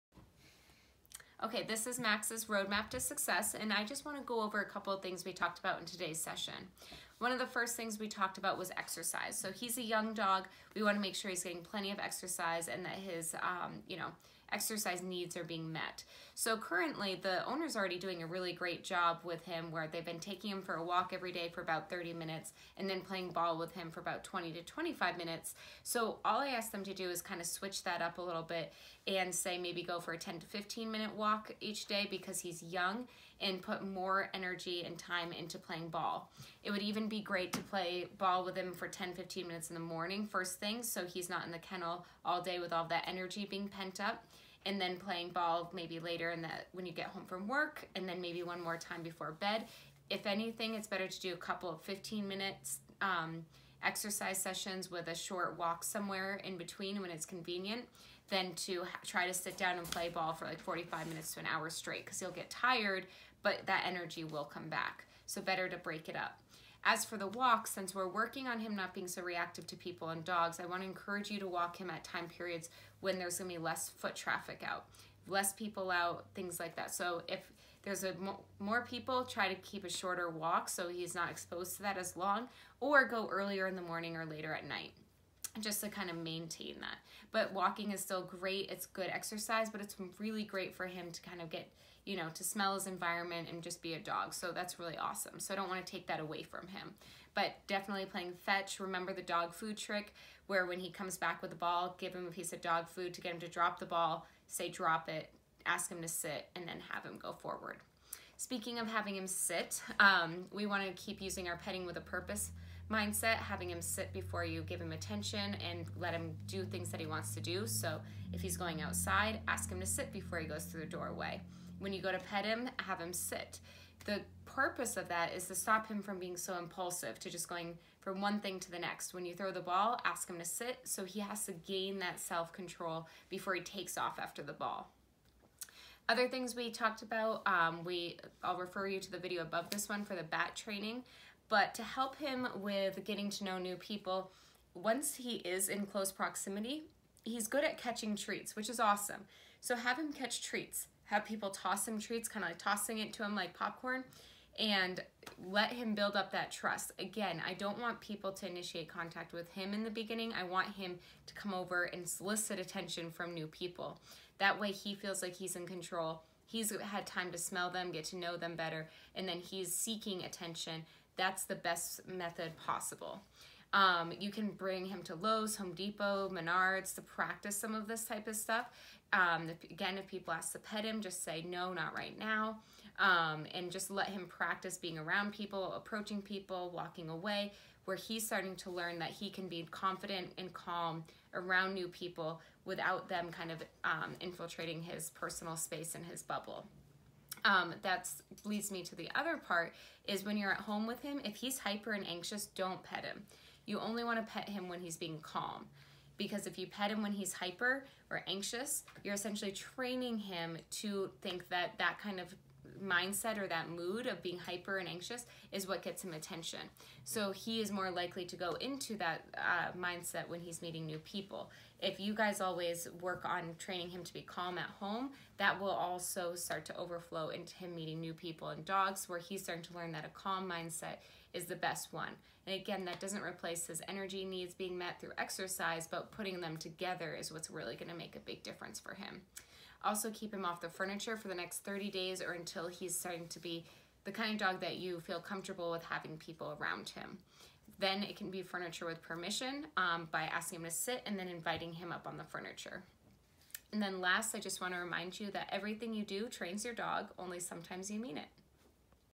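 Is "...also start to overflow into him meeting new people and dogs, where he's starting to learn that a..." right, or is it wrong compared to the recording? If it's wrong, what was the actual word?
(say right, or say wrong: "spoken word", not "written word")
right.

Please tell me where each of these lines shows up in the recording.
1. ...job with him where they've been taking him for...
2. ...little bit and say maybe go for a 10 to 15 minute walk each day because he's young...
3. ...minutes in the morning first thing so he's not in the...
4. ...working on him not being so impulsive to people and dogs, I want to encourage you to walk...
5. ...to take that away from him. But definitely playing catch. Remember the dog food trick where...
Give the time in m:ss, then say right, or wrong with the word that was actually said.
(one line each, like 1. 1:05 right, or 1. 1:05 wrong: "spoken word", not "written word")
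1. 0:18 right
2. 0:28 right
3. 0:39 right
4. 1:08 wrong: "reactive", not "impulsive"
5. 1:35 wrong: "fetch", not "catch".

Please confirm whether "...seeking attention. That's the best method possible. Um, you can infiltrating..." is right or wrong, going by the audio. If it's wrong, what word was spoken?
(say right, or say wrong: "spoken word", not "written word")
wrong: "bring", not "infiltrating".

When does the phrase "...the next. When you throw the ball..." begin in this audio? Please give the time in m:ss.
2:08.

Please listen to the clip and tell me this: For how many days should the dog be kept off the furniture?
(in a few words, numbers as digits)
30.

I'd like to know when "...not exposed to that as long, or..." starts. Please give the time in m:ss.
1:21.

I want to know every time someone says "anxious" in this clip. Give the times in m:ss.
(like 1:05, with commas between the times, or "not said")
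3:22, 3:28, 3:34.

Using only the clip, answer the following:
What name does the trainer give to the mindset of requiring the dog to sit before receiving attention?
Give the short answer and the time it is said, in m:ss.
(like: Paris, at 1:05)
petting with a purpose, at 1:51.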